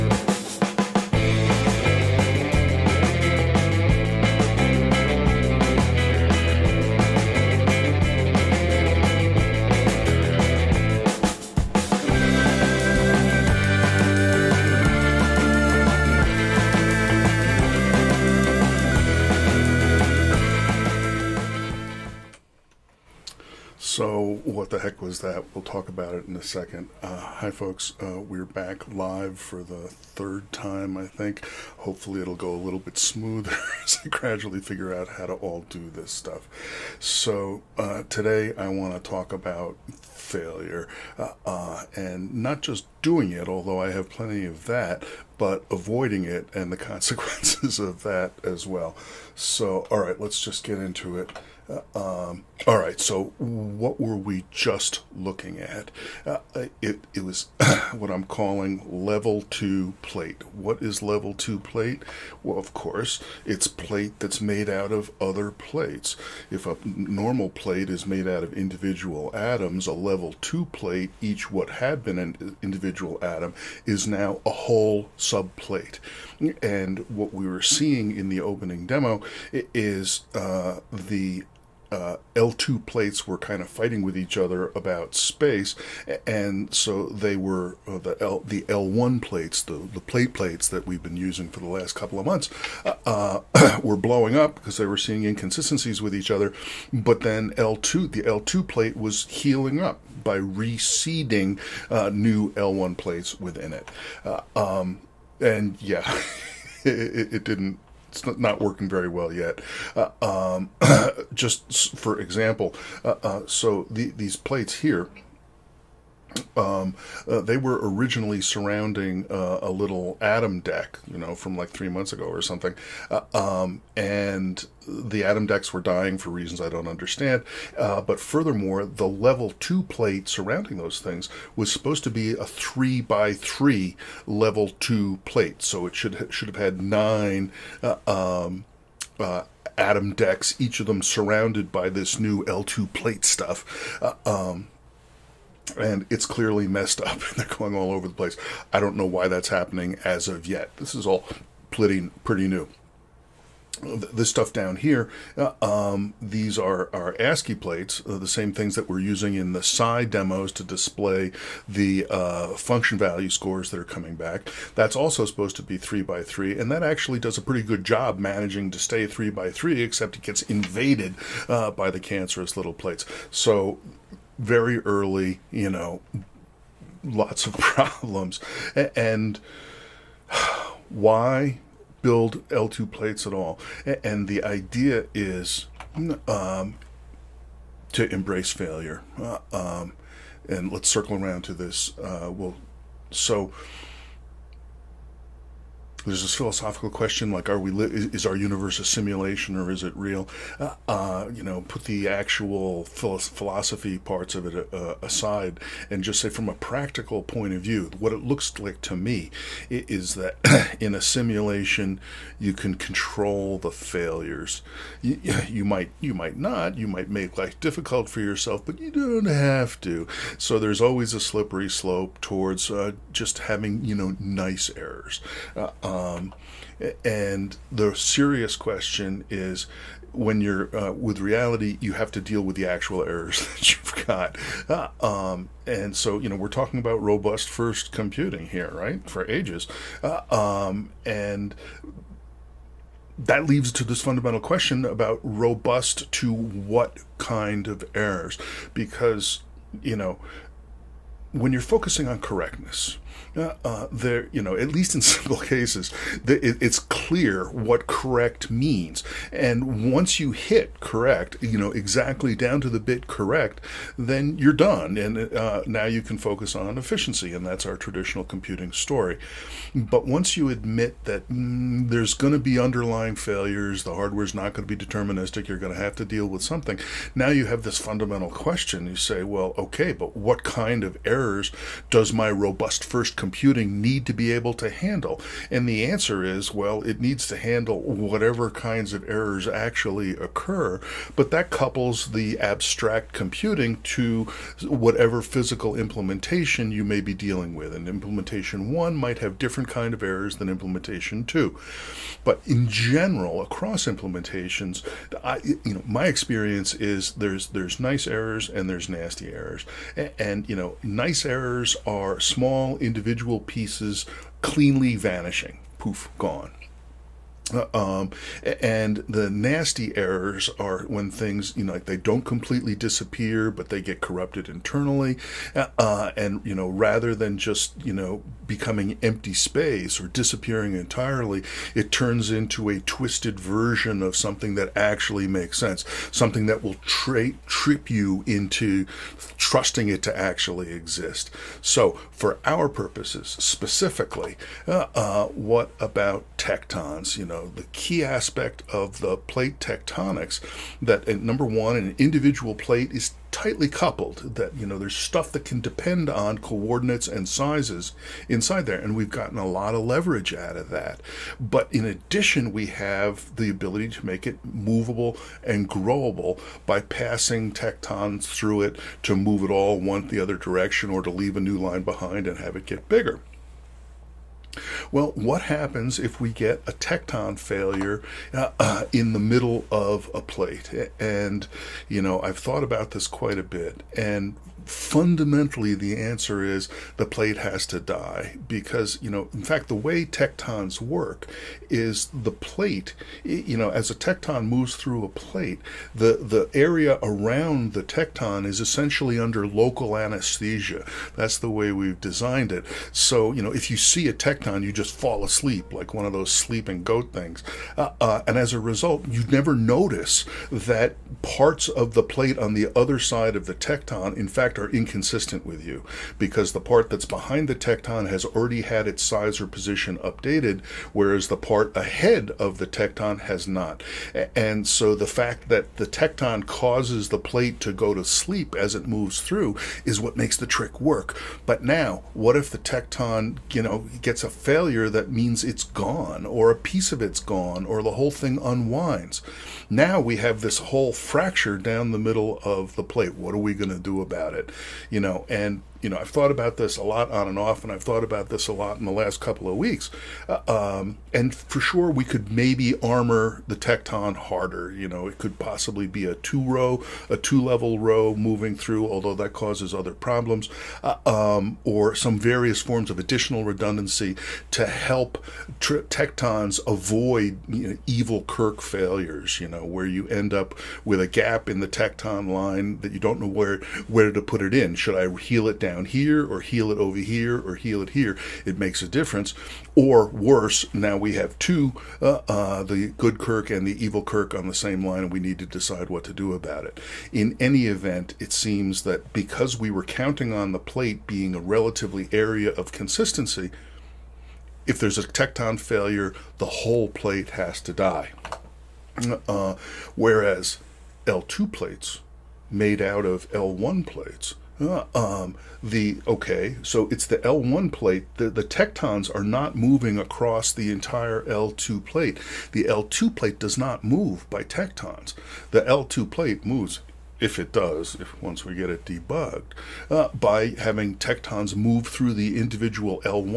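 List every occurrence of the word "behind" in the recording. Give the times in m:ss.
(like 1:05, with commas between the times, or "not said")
6:11, 6:57.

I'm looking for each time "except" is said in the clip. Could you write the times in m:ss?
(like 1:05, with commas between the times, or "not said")
2:49.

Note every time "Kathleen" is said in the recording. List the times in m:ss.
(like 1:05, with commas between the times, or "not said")
not said.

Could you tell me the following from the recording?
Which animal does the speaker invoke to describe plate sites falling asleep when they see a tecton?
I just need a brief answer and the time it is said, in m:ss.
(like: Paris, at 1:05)
goat, at 6:46.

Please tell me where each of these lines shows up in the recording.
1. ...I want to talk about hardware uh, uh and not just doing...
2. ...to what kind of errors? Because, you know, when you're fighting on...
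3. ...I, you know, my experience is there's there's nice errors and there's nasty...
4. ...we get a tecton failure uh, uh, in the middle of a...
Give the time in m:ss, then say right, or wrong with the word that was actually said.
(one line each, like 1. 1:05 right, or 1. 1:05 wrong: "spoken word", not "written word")
1. 0:38 wrong: "failure", not "hardware"
2. 4:06 wrong: "focusing", not "fighting"
3. 5:05 right
4. 6:16 right.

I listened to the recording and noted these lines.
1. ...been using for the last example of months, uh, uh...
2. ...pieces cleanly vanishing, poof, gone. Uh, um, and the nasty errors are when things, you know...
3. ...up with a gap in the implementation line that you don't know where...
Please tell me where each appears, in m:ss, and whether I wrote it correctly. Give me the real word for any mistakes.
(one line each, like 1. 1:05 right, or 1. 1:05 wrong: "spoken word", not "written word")
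1. 1:31 wrong: "couple", not "example"
2. 5:13 right
3. 7:50 wrong: "tecton", not "implementation".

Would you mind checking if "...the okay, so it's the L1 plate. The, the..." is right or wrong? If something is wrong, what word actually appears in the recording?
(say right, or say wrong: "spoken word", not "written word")
right.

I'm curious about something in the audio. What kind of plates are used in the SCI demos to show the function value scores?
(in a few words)
ASCII plates.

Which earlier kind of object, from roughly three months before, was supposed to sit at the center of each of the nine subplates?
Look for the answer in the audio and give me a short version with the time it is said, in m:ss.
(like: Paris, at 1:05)
Atom deck, at 2:00.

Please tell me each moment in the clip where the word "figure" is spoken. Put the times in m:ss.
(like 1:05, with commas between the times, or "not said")
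0:34.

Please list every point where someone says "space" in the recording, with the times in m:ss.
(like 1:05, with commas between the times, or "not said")
1:25, 5:29.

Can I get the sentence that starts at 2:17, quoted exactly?
Uh, um, uh, Atom decks, each of them surrounded by this new L2 plate stuff.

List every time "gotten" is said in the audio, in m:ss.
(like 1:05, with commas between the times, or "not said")
5:59.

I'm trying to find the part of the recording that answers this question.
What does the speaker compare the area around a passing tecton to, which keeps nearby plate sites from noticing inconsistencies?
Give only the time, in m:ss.
6:39.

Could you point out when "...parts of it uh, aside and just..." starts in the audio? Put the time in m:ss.
3:23.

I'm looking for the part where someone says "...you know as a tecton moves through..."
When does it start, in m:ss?
6:33.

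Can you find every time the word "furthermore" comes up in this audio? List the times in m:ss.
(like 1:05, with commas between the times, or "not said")
2:08.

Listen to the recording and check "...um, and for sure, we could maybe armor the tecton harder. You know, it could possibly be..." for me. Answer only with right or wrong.
right.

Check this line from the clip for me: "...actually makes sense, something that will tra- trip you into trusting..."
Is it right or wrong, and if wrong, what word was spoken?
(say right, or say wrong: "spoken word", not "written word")
right.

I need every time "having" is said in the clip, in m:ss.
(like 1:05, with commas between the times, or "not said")
3:43, 8:40.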